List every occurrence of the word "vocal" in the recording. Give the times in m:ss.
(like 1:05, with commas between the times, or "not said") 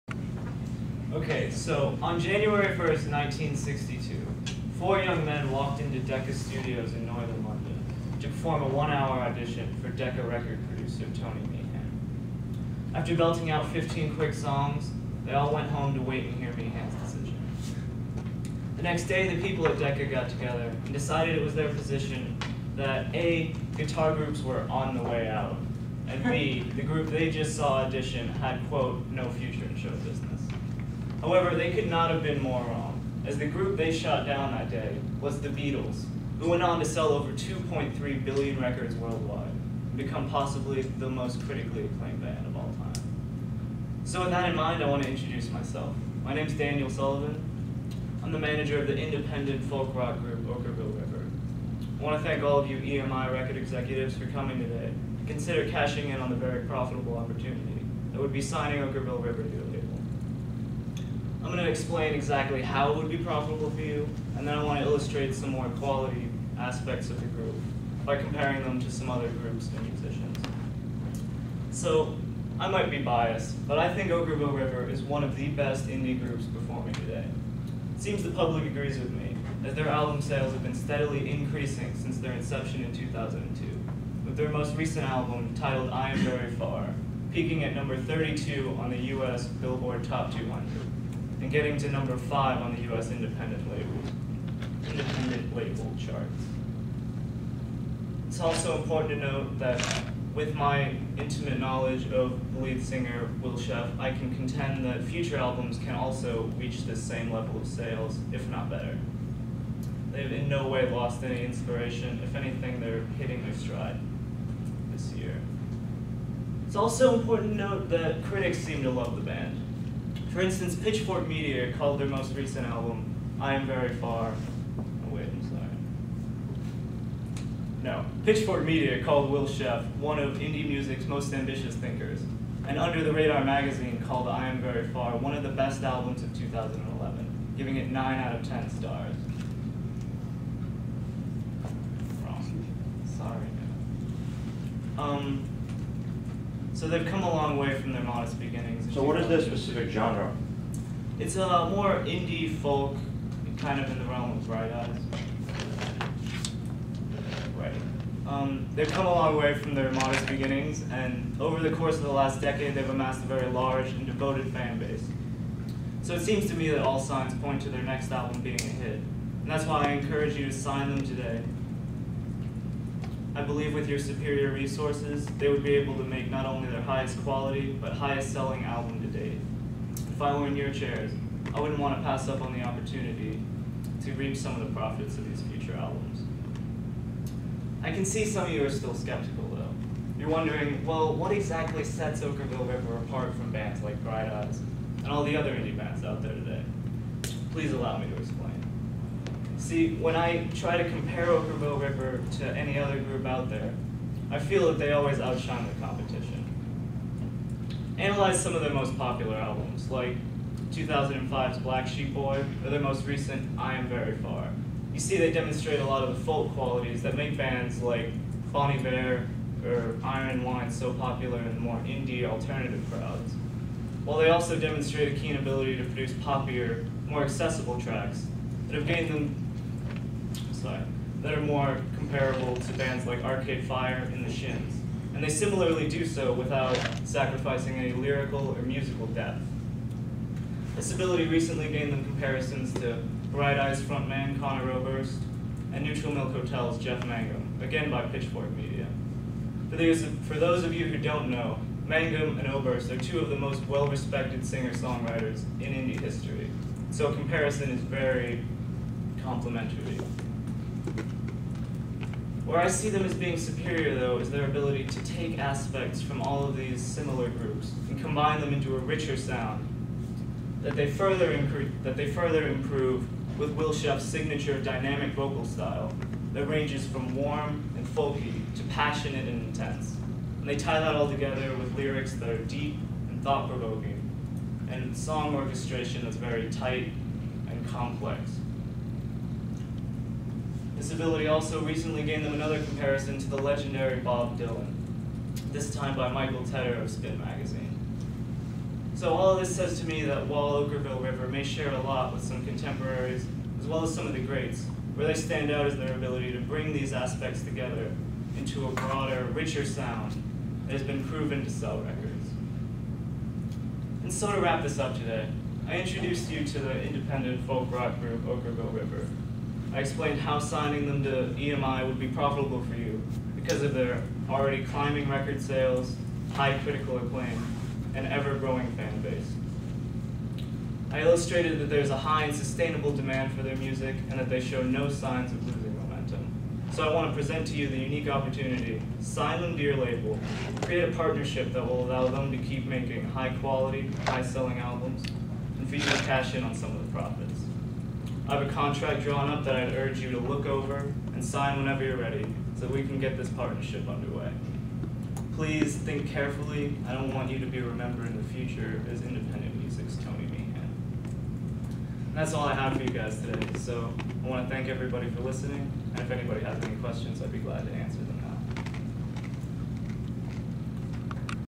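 4:35.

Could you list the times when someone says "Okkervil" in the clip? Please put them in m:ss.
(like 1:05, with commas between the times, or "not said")
0:50, 0:58, 1:14, 3:12, 3:21, 5:00, 5:18.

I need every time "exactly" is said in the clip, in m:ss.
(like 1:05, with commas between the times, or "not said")
1:02, 3:11.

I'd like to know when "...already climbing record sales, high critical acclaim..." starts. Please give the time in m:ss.
5:24.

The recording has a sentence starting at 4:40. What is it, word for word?
And they tie that all together with lyrics that are deep and thought-provoking and song orchestration that's very tight and complex.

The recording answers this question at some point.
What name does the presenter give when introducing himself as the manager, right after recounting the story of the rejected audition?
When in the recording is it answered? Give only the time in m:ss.
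0:46.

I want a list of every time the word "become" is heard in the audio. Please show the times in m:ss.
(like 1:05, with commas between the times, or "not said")
0:39.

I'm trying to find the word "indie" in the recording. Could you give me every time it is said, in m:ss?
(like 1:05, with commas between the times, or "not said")
1:15, 2:10, 2:32, 3:15, 3:41, 4:15.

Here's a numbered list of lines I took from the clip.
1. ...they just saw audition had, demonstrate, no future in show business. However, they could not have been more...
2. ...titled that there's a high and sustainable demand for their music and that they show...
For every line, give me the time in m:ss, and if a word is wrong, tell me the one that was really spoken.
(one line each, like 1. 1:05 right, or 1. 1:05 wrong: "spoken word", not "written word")
1. 0:27 wrong: "quote", not "demonstrate"
2. 5:31 wrong: "illustrated", not "titled".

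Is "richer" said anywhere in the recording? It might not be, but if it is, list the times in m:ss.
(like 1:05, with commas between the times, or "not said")
4:28, 5:09.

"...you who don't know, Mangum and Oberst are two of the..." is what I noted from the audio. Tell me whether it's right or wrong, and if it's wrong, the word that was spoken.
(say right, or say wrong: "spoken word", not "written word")
right.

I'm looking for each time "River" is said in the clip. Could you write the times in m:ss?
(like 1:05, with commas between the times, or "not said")
0:50, 0:59, 1:14, 3:12, 3:21, 5:01, 5:18.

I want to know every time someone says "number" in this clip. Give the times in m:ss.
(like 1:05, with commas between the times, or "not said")
1:27, 1:31.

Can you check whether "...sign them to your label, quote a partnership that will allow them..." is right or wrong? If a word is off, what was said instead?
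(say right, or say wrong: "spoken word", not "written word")
wrong: "create", not "quote".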